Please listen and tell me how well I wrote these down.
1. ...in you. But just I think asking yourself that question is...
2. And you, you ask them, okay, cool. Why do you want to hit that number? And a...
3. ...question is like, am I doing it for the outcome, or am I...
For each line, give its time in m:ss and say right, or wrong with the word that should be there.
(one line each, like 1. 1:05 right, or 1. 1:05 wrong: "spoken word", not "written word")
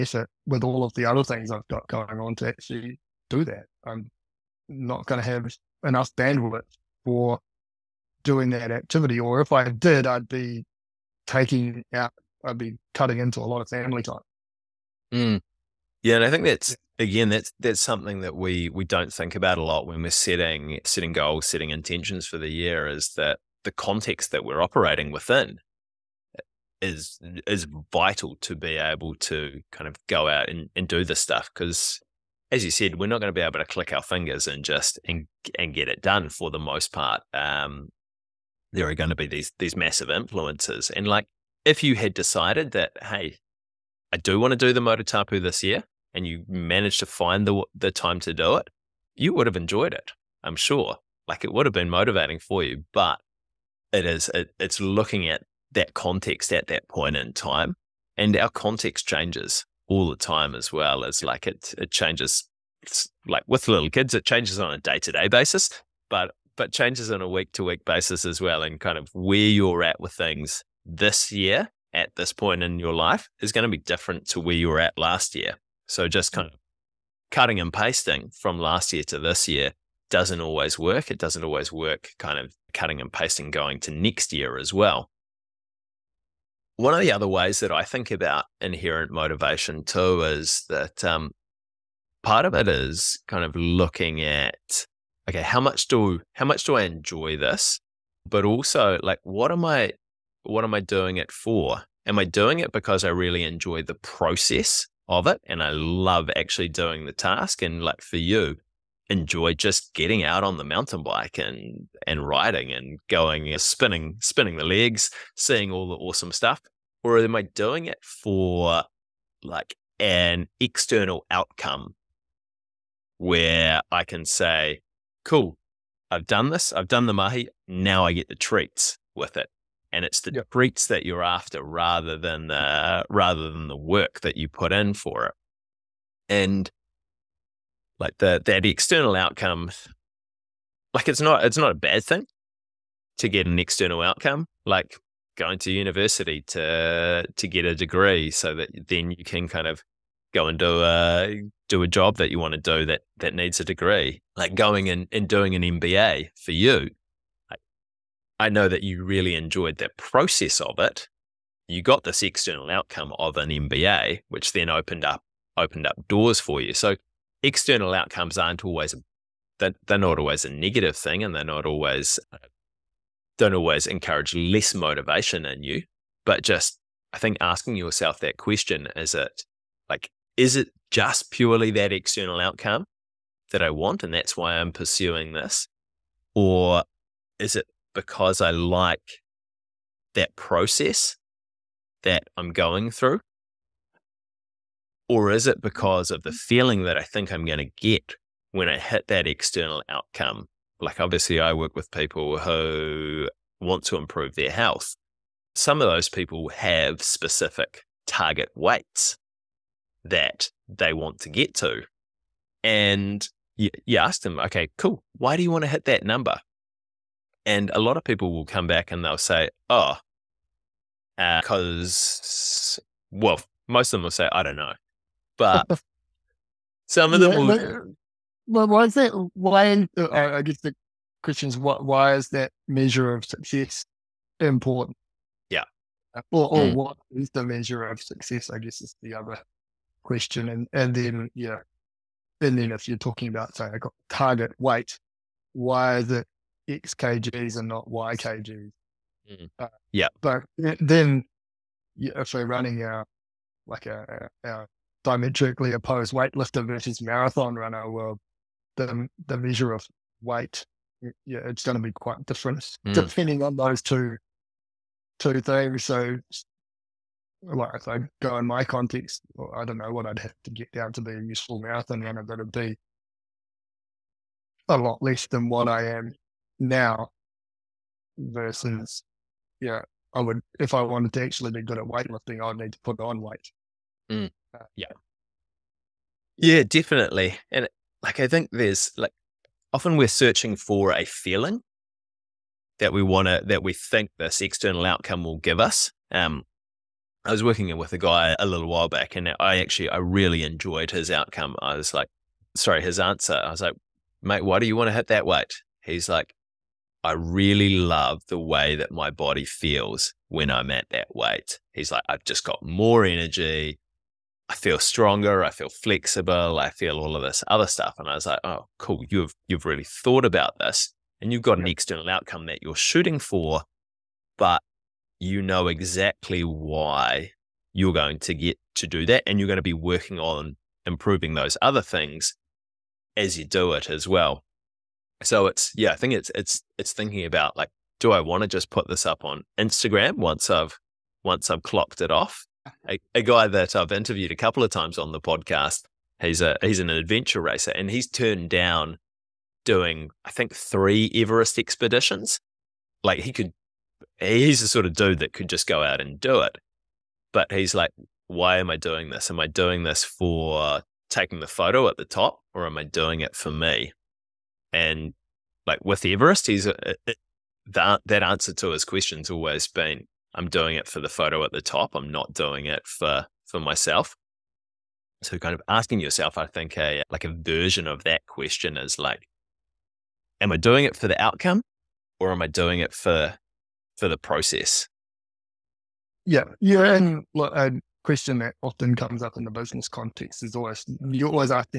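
1. 2:55 right
2. 3:32 right
3. 6:18 right.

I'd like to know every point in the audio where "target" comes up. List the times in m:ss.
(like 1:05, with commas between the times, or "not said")
3:28, 4:04.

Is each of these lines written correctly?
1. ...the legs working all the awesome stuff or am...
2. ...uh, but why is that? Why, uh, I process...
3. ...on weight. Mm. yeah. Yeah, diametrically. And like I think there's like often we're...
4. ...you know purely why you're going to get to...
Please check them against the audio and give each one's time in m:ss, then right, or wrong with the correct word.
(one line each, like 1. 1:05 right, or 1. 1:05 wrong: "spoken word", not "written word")
1. 1:54 wrong: "seeing", not "working"
2. 3:47 wrong: "guess", not "process"
3. 4:42 wrong: "definitely", not "diametrically"
4. 5:25 wrong: "exactly", not "purely".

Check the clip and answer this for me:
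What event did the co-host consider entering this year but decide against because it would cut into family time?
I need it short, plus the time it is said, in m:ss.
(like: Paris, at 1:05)
Motatapu, at 0:44.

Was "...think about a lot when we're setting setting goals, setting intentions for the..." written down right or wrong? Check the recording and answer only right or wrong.
right.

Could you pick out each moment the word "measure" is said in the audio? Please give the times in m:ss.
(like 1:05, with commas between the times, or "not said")
3:52, 3:57, 4:19.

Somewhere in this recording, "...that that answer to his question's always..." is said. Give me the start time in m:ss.
6:07.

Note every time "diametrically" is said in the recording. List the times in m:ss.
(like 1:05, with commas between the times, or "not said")
4:15.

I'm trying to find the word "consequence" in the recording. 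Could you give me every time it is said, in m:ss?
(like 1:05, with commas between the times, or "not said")
not said.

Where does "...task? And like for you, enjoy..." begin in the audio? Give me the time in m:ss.
1:47.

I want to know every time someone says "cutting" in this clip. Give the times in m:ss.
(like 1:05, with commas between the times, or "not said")
0:12, 1:17, 1:22.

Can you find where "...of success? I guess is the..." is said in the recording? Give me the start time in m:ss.
3:57.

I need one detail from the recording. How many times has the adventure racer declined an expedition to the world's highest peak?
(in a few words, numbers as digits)
3.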